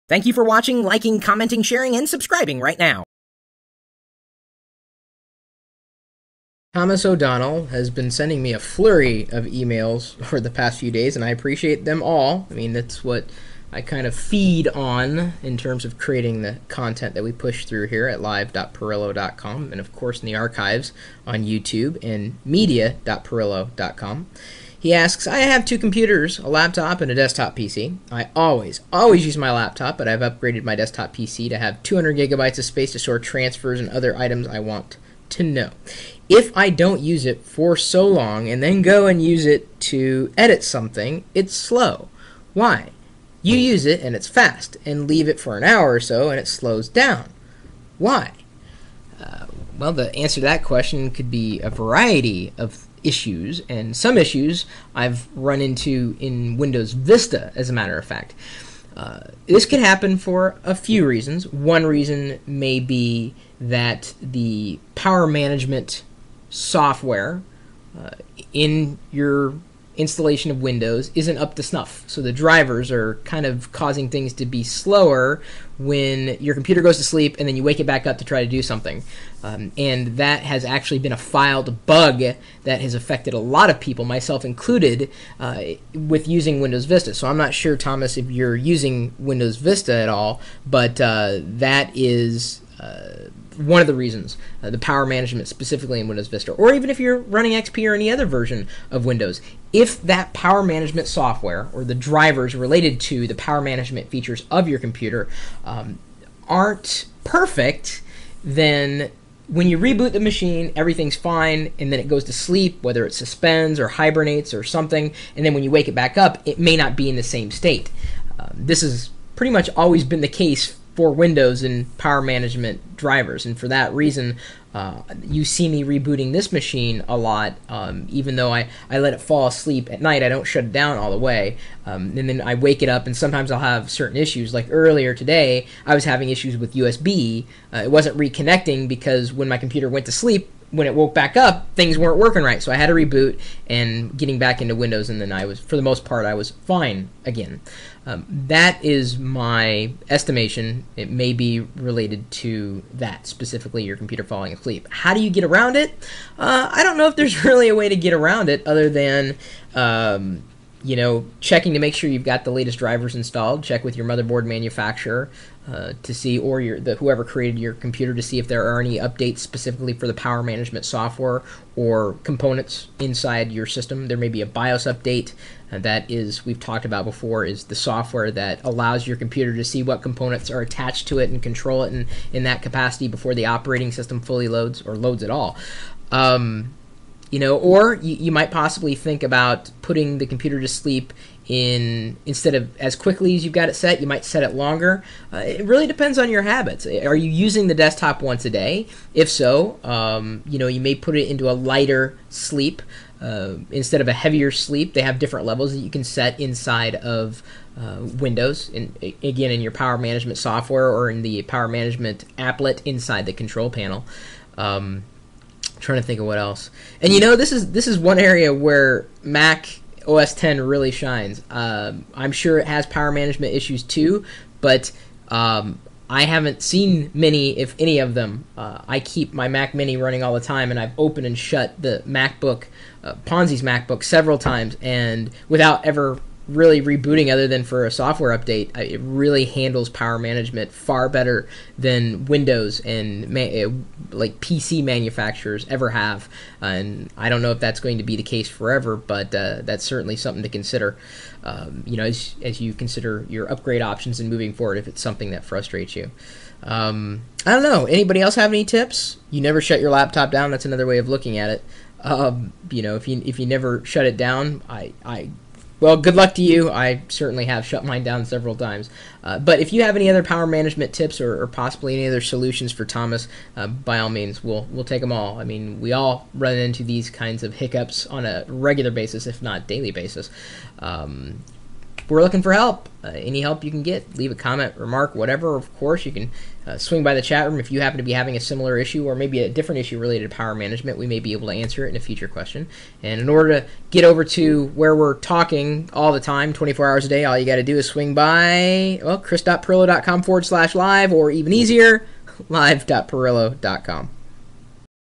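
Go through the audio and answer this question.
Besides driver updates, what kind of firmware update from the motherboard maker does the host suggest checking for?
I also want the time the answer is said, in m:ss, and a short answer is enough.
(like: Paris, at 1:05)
BIOS update, at 2:54.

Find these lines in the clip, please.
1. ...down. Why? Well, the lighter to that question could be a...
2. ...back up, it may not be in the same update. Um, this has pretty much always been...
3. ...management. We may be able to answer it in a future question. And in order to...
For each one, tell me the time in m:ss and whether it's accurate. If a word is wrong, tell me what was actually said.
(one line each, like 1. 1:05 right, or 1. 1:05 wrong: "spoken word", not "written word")
1. 0:46 wrong: "answer", not "lighter"
2. 1:55 wrong: "state", not "update"
3. 4:50 right.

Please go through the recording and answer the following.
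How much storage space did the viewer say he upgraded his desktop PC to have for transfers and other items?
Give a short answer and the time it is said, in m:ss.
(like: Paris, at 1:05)
200 gigabytes, at 0:31.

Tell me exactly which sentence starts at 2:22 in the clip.
So I had to reboot and getting back into Windows, and then I was, for the most part, I was fine again.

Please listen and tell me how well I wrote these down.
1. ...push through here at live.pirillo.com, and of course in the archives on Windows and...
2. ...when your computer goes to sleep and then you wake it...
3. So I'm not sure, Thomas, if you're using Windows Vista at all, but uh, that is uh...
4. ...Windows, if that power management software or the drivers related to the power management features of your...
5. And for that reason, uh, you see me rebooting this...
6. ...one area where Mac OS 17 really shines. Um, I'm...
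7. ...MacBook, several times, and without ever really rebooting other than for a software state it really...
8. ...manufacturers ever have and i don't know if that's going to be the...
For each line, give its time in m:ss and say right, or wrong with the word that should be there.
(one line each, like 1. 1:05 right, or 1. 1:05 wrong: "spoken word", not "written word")
1. 0:17 wrong: "YouTube", not "Windows"
2. 1:15 right
3. 1:27 right
4. 1:39 right
5. 2:03 right
6. 3:37 wrong: "10", not "17"
7. 3:53 wrong: "update", not "state"
8. 4:04 right.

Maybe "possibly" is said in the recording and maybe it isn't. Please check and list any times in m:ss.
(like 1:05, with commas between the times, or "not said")
3:08, 4:31.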